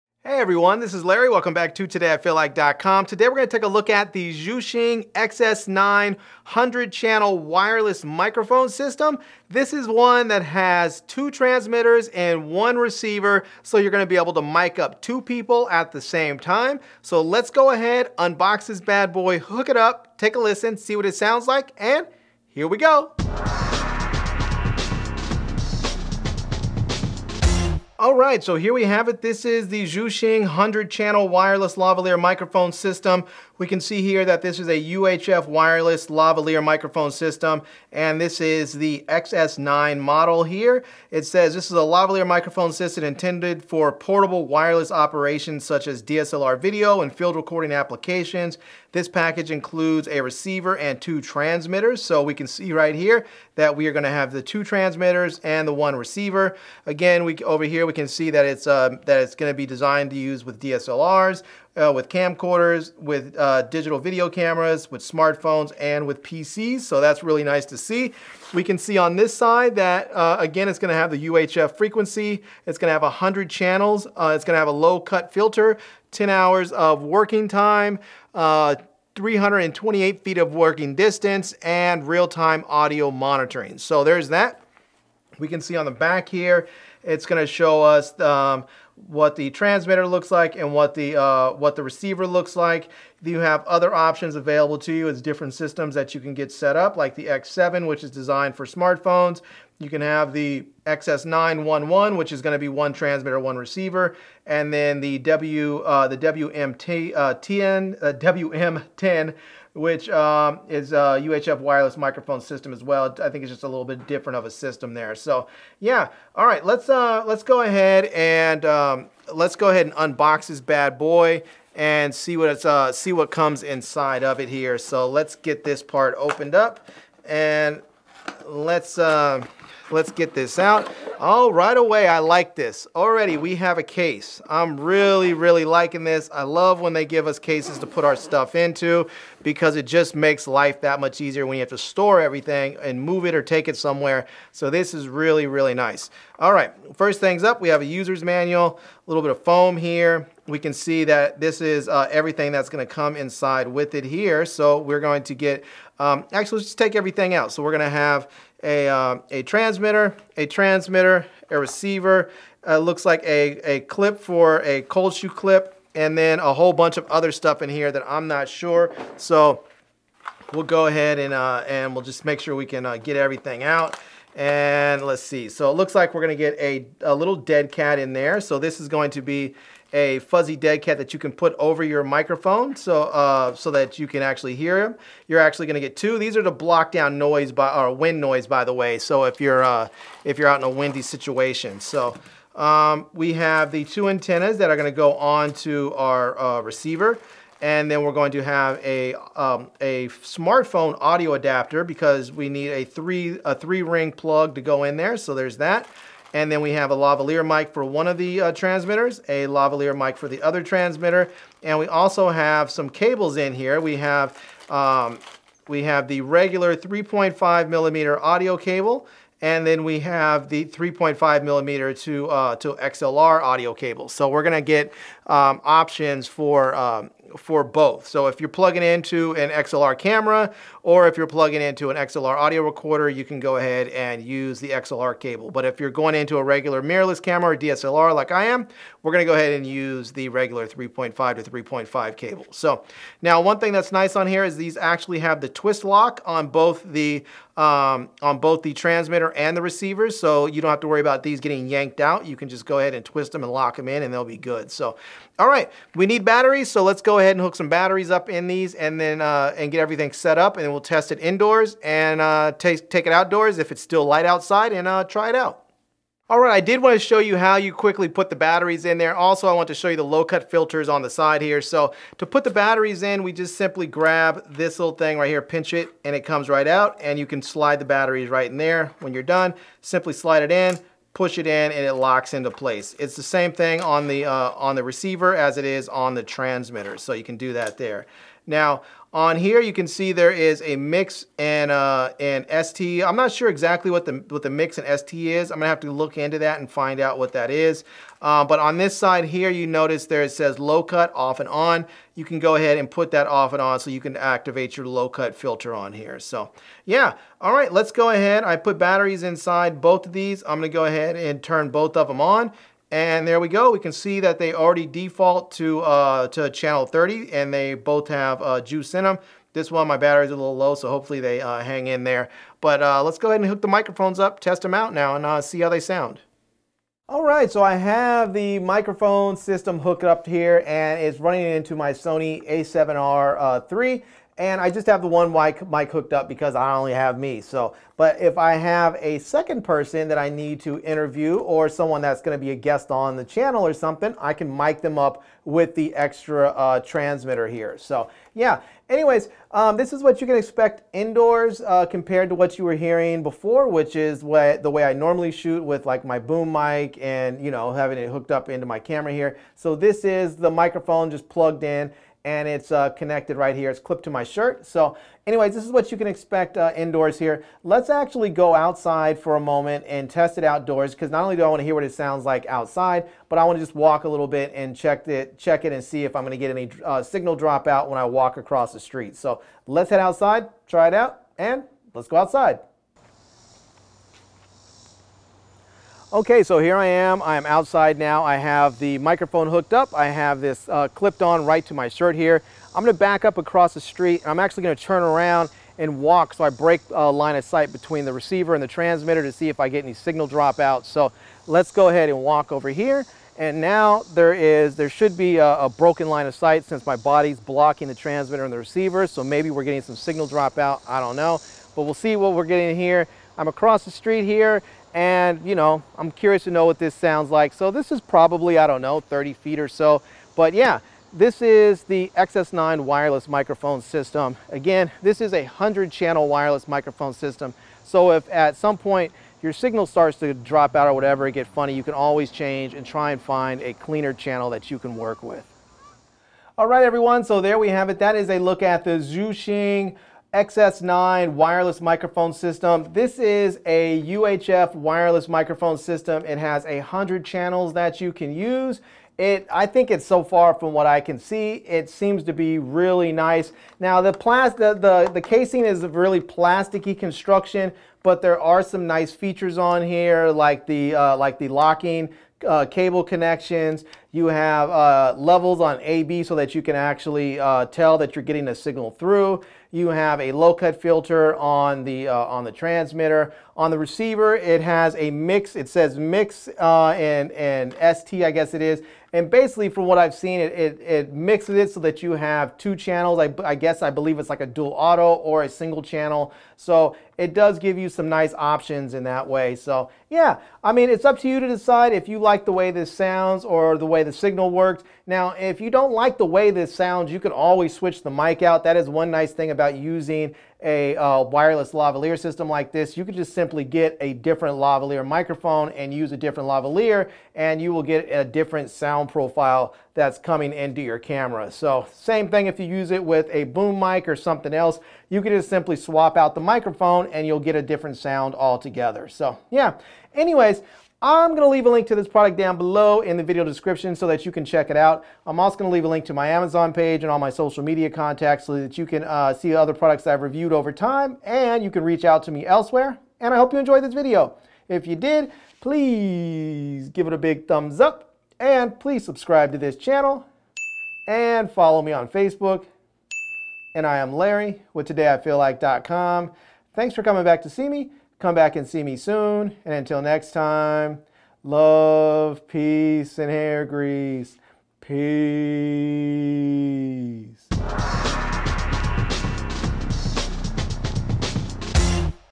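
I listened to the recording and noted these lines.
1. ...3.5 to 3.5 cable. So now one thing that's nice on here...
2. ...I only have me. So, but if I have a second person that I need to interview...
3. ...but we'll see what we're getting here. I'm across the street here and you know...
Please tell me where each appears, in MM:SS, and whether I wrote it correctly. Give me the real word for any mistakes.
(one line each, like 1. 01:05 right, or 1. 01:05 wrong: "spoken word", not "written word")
1. 04:00 right
2. 05:36 right
3. 06:51 right.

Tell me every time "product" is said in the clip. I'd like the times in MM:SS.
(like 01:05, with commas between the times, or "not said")
08:42, 08:49.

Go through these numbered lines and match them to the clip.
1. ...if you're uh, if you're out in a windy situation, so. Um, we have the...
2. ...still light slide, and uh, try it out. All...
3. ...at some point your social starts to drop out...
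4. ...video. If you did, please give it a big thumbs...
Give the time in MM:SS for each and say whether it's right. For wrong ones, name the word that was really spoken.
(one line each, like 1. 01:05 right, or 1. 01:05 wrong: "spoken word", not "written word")
1. 03:09 right
2. 04:23 wrong: "outside", not "slide"
3. 07:08 wrong: "signal", not "social"
4. 08:53 right.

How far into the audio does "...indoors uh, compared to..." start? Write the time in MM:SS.
05:50.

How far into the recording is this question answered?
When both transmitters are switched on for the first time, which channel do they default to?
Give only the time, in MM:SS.
05:16.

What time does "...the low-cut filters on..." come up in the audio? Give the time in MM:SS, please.
04:29.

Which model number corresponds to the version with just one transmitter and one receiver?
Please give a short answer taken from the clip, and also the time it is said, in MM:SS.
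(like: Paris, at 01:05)
XS911, at 01:40.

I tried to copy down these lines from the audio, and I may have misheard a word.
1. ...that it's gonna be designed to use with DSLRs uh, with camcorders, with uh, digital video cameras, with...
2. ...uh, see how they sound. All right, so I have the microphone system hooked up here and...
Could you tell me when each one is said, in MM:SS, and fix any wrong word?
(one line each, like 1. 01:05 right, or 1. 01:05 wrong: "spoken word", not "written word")
1. 00:59 right
2. 05:25 right.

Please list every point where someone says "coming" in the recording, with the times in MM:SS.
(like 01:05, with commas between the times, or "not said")
08:30, 09:07.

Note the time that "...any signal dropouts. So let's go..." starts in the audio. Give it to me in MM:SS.
06:39.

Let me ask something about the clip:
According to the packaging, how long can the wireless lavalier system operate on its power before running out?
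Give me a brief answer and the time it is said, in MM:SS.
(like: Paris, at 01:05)
10 hours, at 01:16.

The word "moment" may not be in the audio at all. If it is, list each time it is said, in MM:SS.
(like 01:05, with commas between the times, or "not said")
06:09.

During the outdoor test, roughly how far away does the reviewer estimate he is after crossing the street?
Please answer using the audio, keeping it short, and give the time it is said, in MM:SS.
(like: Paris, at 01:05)
30 feet, at 06:58.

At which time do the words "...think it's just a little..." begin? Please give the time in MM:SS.
01:53.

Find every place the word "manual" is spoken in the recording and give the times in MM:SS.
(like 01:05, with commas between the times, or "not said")
02:28.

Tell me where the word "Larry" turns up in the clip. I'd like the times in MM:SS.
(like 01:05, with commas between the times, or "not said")
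00:01, 09:04.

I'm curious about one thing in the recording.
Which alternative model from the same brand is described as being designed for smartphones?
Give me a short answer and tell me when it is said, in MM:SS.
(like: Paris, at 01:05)
X7, at 01:37.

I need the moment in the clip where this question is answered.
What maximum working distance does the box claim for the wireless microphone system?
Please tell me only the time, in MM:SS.
01:19.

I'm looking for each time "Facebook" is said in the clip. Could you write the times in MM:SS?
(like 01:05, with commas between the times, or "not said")
09:02.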